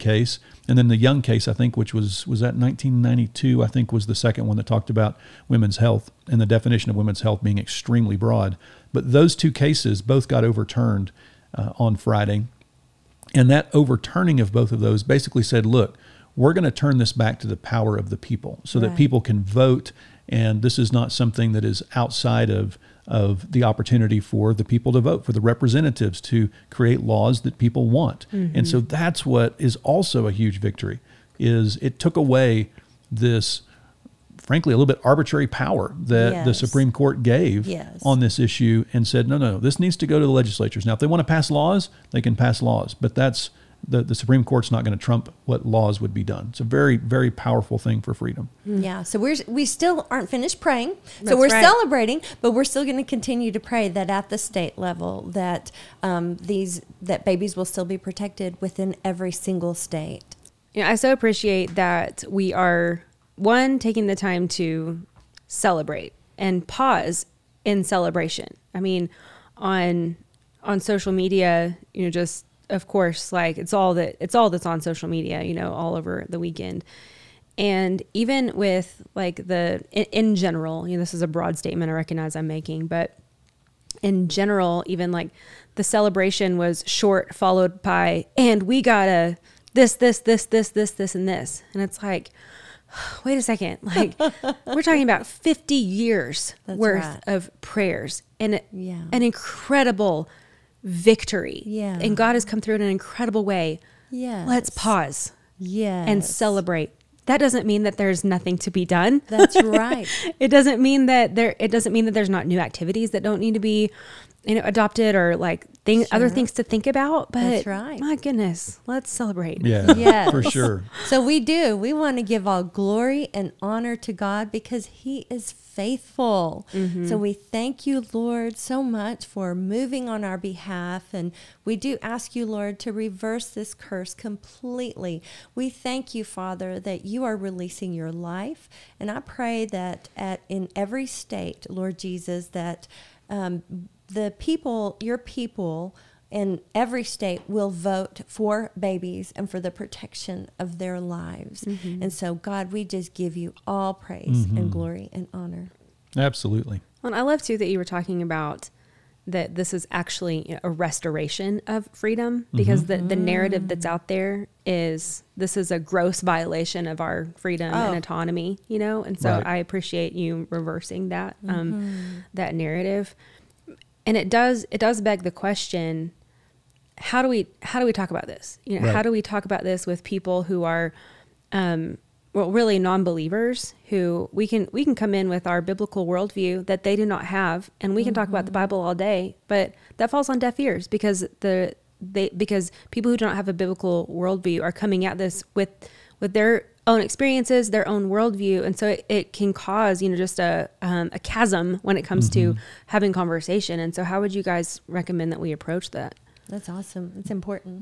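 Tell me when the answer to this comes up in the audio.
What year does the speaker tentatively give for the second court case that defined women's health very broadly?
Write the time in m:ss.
0:02.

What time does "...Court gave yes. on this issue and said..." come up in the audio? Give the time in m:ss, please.
0:36.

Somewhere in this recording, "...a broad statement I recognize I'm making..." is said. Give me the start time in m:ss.
1:21.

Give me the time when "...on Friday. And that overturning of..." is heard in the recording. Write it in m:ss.
0:11.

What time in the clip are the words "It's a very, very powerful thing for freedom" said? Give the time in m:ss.
0:46.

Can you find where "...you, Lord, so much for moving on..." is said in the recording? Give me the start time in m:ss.
2:07.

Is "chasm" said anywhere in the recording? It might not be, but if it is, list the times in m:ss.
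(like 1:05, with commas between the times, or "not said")
3:21.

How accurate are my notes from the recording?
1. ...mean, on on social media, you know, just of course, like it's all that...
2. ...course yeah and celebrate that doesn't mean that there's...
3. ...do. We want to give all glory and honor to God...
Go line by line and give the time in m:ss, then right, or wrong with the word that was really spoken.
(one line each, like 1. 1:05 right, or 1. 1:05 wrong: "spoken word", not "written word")
1. 1:08 right
2. 1:44 wrong: "pause", not "course"
3. 2:01 right.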